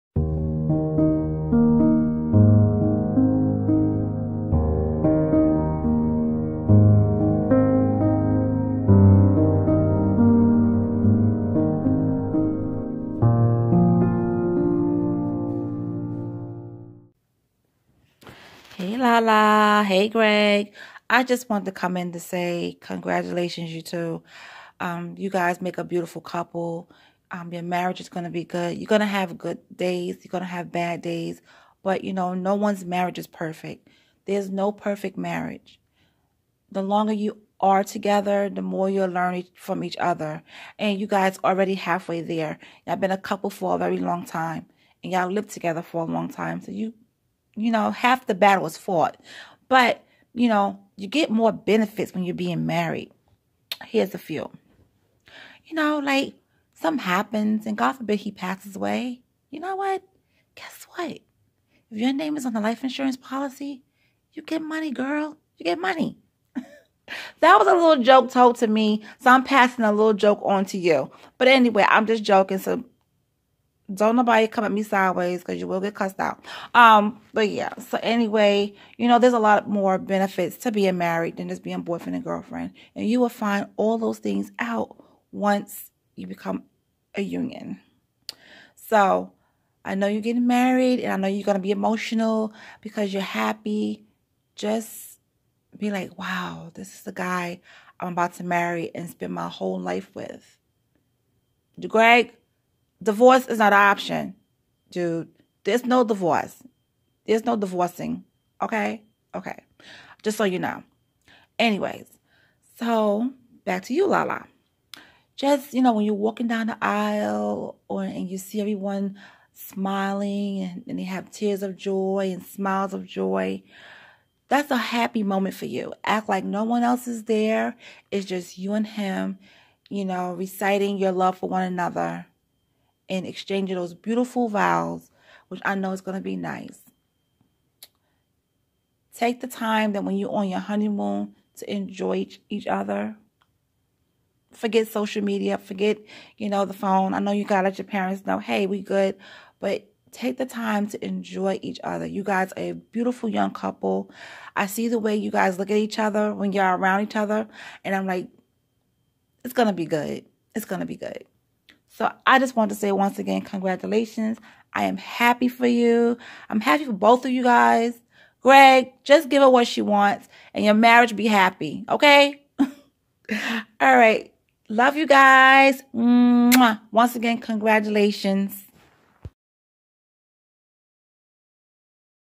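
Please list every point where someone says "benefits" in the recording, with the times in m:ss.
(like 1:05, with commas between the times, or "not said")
0:51, 1:19.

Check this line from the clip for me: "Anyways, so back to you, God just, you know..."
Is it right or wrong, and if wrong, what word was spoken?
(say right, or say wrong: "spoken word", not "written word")
wrong: "Lala", not "God".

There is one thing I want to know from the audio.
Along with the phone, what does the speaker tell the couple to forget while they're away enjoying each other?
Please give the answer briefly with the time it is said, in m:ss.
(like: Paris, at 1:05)
social media, at 2:24.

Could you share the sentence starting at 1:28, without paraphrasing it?
So I know you're getting married and I know you're going to be emotional because you're happy.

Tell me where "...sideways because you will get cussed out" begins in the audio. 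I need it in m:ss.
1:14.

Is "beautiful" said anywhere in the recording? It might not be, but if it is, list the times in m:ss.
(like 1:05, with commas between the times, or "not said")
0:25, 2:13, 2:32.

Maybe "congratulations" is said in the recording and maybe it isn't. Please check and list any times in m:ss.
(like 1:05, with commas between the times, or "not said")
0:22, 2:43, 2:57.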